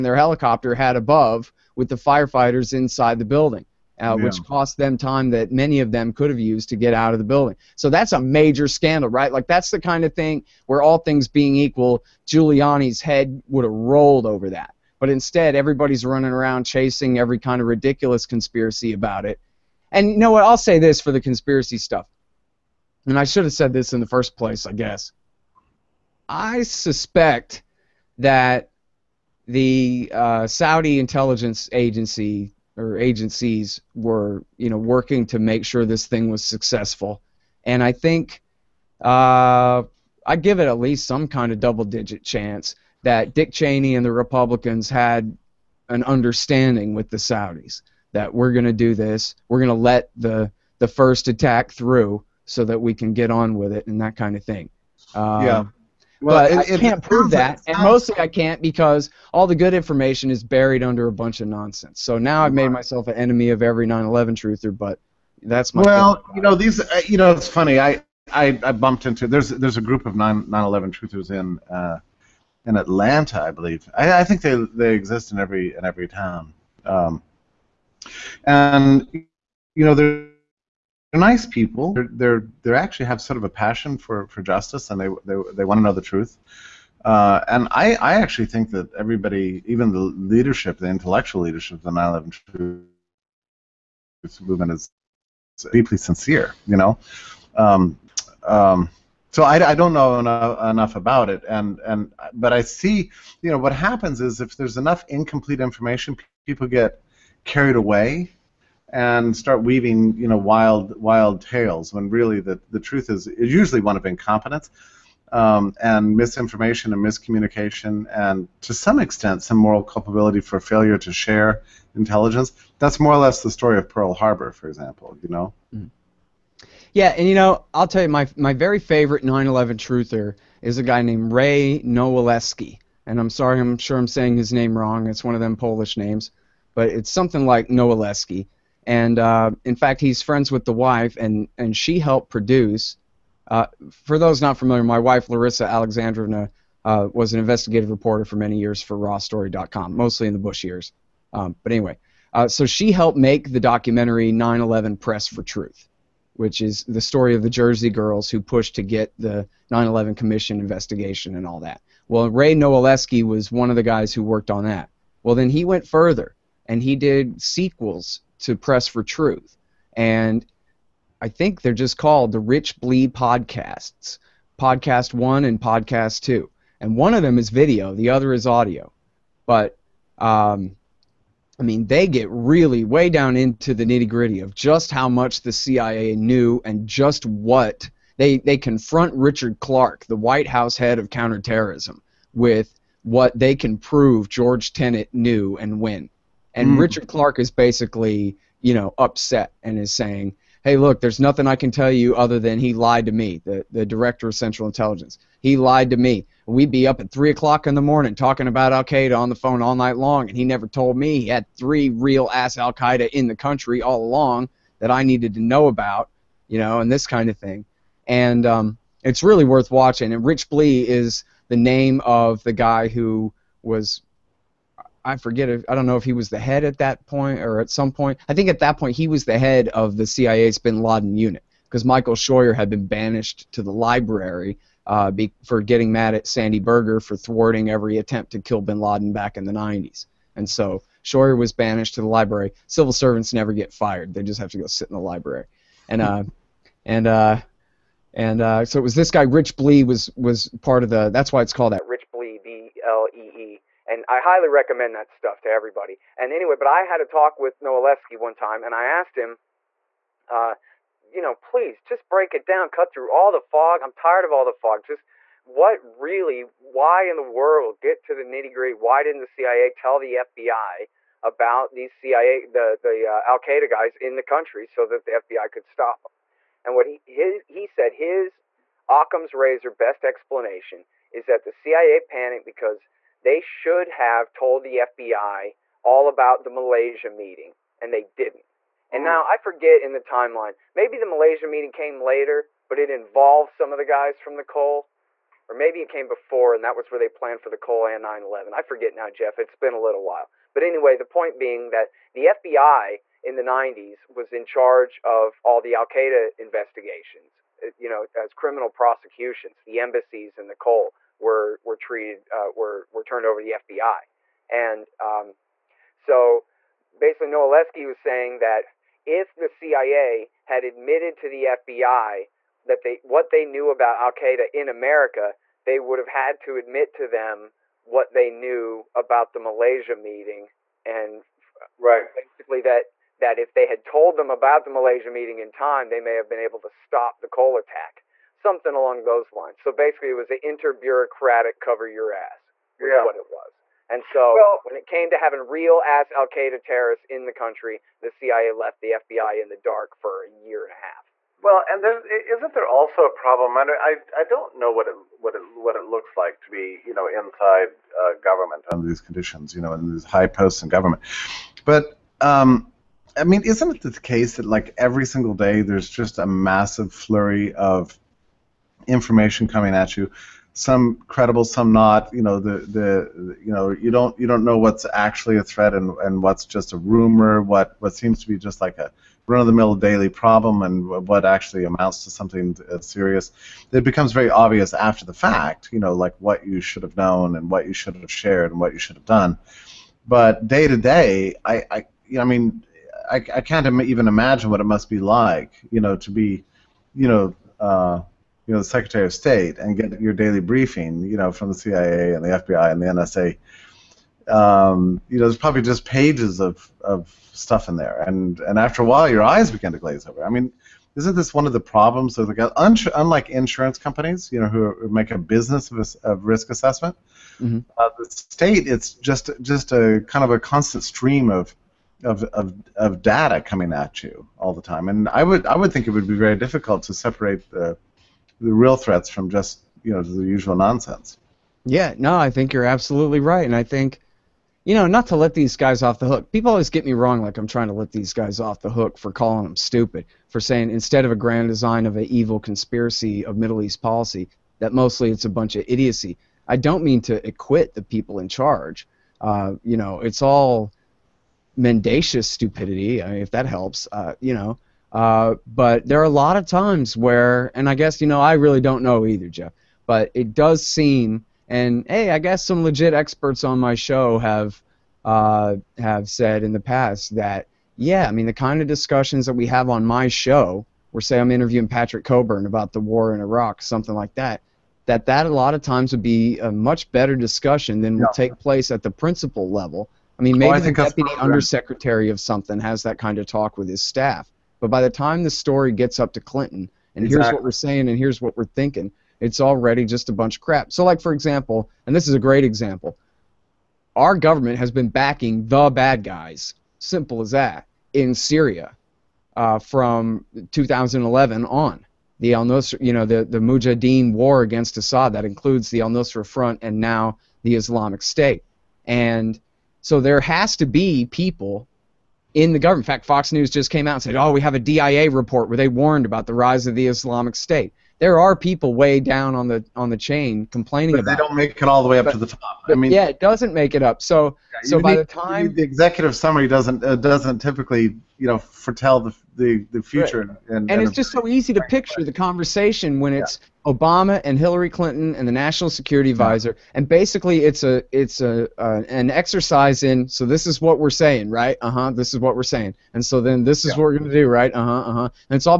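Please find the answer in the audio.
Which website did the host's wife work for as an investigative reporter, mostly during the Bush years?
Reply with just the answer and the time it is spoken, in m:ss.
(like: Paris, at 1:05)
RawStory.com, at 2:28.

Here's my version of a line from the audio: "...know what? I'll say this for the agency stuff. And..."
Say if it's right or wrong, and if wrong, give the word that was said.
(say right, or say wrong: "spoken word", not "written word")
wrong: "conspiracy", not "agency".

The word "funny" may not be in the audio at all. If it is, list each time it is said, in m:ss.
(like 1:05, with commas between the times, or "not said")
1:07.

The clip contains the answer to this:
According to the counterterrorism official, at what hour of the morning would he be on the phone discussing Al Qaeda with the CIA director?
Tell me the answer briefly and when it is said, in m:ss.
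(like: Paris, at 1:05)
3 o'clock, at 3:27.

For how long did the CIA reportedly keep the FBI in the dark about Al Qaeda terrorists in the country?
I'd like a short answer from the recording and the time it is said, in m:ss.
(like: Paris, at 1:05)
a year and a half, at 5:50.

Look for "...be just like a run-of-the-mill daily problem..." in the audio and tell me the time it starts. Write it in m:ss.
6:18.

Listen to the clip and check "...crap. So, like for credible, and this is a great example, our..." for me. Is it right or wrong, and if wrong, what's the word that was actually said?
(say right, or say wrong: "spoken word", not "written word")
wrong: "example", not "credible".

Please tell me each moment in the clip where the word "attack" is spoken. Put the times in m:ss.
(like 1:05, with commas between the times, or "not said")
0:51, 5:37.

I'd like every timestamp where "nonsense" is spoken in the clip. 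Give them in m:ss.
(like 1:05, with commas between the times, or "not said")
1:01, 7:10.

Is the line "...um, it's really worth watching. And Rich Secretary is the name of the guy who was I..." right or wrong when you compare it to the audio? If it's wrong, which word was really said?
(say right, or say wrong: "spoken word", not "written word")
wrong: "Blee", not "Secretary".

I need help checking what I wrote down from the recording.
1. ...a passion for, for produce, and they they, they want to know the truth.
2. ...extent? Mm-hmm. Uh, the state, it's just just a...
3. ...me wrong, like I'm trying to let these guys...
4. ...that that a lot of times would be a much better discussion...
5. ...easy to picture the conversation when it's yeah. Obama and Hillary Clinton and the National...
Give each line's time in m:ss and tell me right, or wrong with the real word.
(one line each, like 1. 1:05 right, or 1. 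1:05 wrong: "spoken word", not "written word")
1. 1:23 wrong: "justice", not "produce"
2. 6:56 wrong: "assessment", not "extent"
3. 7:16 right
4. 7:54 right
5. 8:51 right.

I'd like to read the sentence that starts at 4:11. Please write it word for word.
That's why it's called that Rich Blee B L E E.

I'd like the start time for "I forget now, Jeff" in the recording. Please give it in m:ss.
4:58.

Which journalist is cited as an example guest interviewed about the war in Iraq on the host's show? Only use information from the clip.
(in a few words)
Patrick Cockburn.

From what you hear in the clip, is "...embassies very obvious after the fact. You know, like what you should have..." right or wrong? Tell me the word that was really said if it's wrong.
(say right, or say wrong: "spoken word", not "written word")
wrong: "becomes", not "embassies".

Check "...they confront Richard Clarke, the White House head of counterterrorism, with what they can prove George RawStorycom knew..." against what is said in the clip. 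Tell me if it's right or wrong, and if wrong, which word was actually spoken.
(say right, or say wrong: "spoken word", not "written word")
wrong: "Tenet", not "RawStorycom".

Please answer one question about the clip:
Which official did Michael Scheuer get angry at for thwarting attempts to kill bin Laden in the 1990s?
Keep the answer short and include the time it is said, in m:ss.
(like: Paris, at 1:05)
Sandy Berger, at 3:56.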